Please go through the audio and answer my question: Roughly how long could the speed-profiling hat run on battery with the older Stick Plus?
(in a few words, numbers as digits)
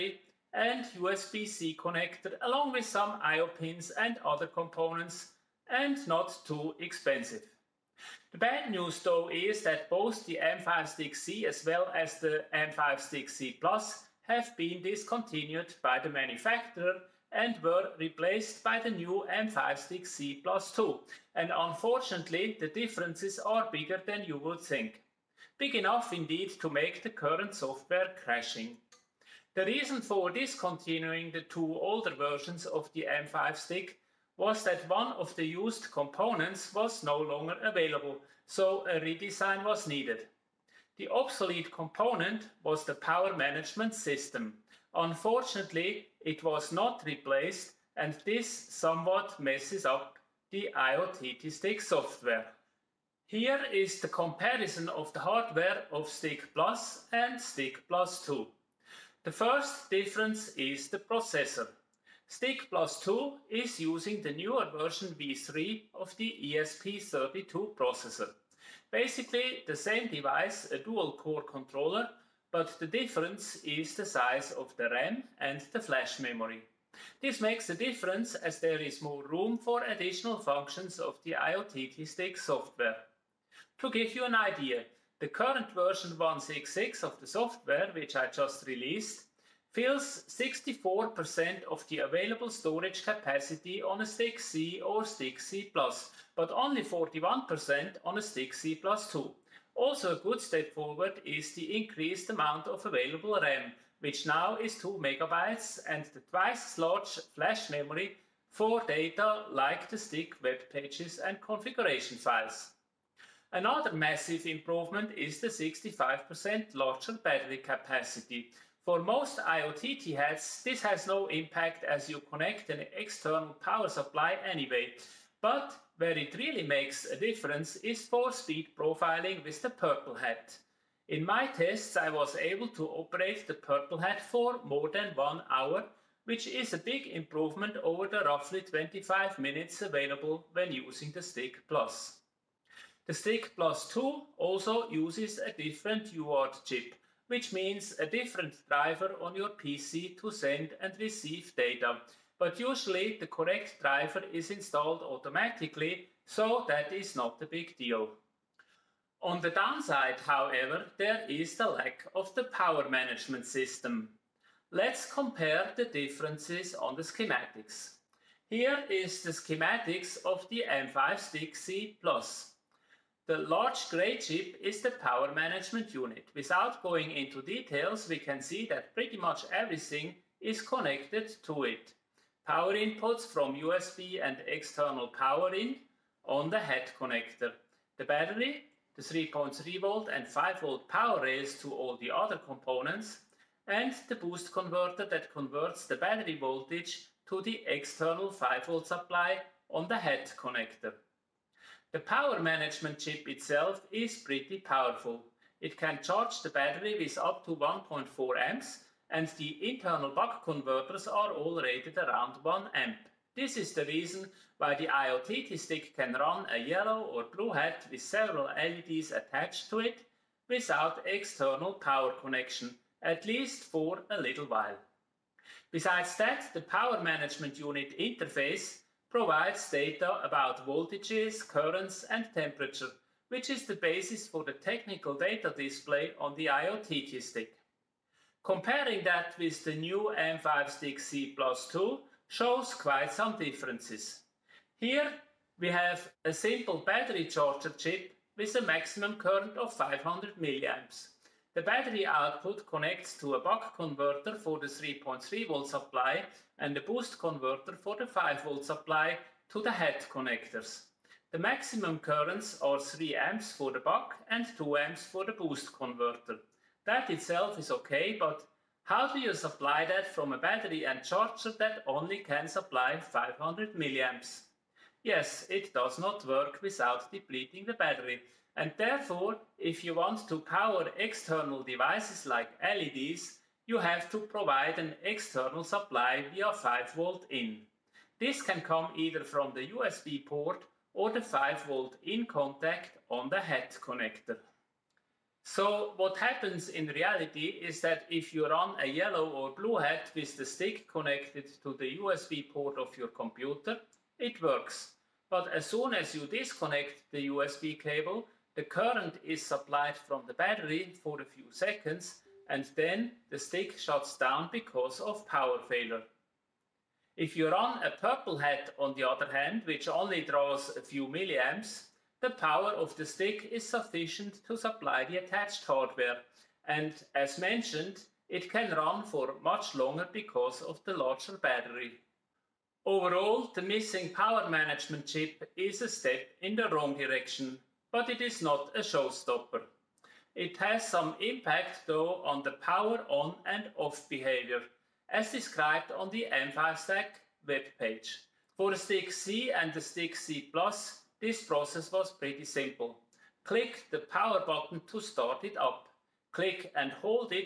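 25 minutes.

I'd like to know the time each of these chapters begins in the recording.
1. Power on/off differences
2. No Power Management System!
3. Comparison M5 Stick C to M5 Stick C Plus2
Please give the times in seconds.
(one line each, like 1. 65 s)
1. 340 s
2. 157 s
3. 50 s.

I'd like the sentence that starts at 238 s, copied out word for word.
Comparing that with the new M5 Stick C Plus 2 shows quite some differences.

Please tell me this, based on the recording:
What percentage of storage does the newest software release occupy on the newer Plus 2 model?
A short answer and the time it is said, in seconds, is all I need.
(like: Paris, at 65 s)
41%, at 96 s.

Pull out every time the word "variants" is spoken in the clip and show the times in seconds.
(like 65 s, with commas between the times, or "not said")
not said.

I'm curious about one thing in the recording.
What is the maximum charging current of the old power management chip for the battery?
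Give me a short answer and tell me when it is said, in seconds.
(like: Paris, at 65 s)
1.4 amps, at 207 s.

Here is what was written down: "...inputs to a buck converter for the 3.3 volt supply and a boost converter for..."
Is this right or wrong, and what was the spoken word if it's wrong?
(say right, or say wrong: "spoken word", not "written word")
wrong: "connects", not "inputs".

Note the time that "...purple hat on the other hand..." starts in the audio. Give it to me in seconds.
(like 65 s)
317 s.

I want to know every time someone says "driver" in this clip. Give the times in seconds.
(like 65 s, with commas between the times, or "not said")
148 s, 153 s.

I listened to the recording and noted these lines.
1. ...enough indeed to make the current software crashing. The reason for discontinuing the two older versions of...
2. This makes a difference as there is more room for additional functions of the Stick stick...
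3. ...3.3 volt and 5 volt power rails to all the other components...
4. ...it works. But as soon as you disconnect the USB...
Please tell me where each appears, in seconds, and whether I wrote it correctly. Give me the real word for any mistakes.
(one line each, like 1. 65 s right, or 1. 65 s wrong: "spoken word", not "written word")
1. 25 s right
2. 77 s wrong: "IoTT", not "Stick"
3. 189 s right
4. 304 s right.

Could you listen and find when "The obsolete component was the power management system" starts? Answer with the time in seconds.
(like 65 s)
40 s.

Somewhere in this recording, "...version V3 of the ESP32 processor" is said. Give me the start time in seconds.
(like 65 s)
64 s.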